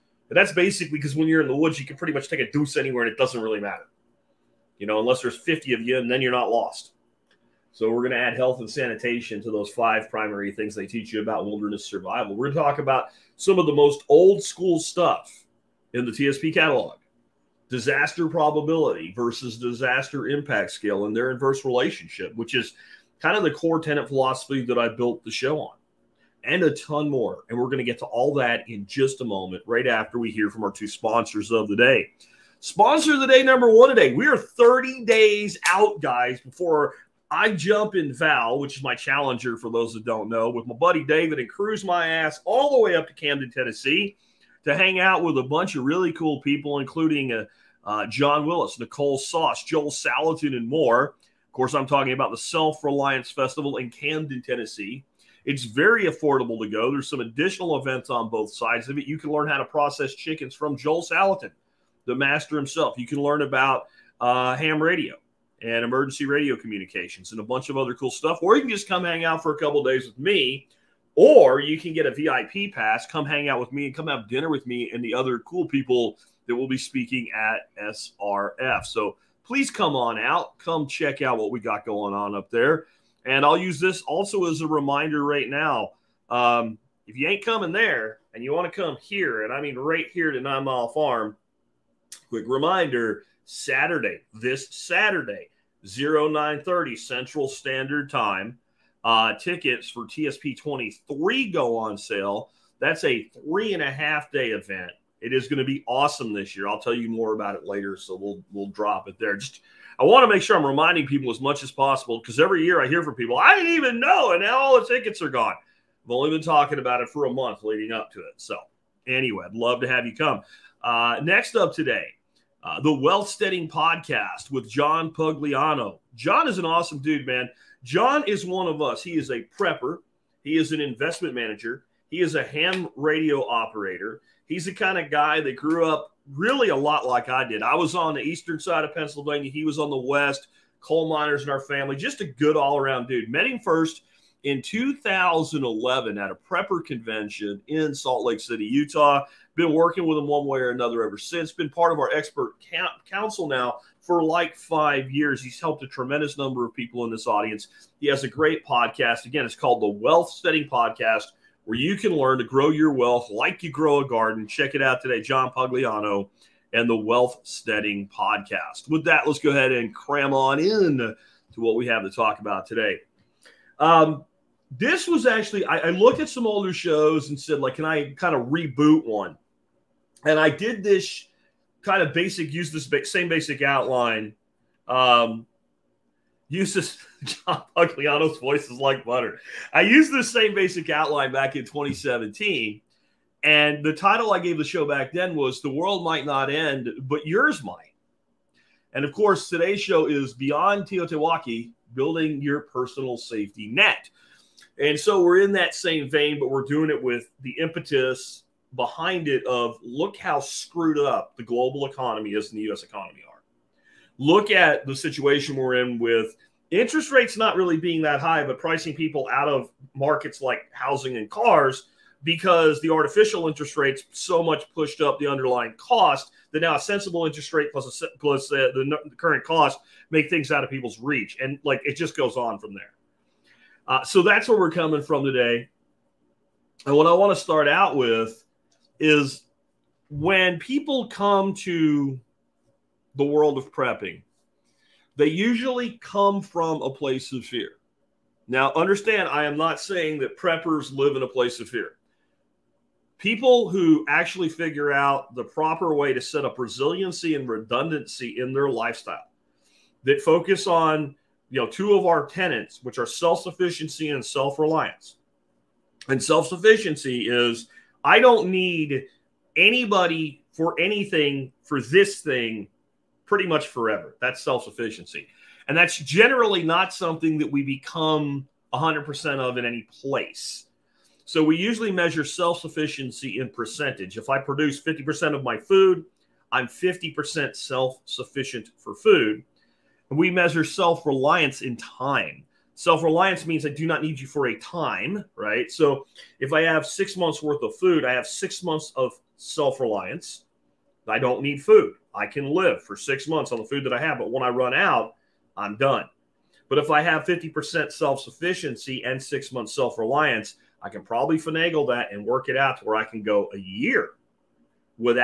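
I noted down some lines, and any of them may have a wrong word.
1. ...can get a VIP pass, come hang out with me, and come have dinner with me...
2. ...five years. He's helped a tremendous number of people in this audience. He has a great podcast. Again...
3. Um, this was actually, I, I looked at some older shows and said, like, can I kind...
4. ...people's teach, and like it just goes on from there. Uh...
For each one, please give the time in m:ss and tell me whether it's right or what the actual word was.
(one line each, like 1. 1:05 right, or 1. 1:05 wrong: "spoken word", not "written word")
1. 1:11 right
2. 2:34 right
3. 2:53 right
4. 3:50 wrong: "reach", not "teach".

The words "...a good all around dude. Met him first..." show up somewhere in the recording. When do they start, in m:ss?
2:22.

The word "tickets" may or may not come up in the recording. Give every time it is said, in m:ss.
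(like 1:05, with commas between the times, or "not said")
1:39, 1:54.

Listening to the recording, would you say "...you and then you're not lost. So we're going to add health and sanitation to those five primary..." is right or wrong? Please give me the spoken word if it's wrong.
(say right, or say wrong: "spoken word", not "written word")
right.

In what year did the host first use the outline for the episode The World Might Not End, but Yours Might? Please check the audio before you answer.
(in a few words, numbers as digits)
2017.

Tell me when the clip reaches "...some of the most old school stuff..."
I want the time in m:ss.
0:13.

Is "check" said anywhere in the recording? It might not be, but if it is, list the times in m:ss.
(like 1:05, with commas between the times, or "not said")
1:20, 2:44.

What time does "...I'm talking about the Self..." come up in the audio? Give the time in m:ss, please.
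0:51.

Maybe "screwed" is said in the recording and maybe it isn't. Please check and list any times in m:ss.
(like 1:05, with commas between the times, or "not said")
3:30.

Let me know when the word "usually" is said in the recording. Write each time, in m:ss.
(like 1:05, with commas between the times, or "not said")
4:05, 4:41.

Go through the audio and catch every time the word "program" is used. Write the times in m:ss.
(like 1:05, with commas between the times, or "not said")
not said.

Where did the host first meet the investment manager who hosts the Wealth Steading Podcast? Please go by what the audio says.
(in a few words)
Salt Lake City, Utah.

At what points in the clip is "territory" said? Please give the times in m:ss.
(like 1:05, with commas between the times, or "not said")
not said.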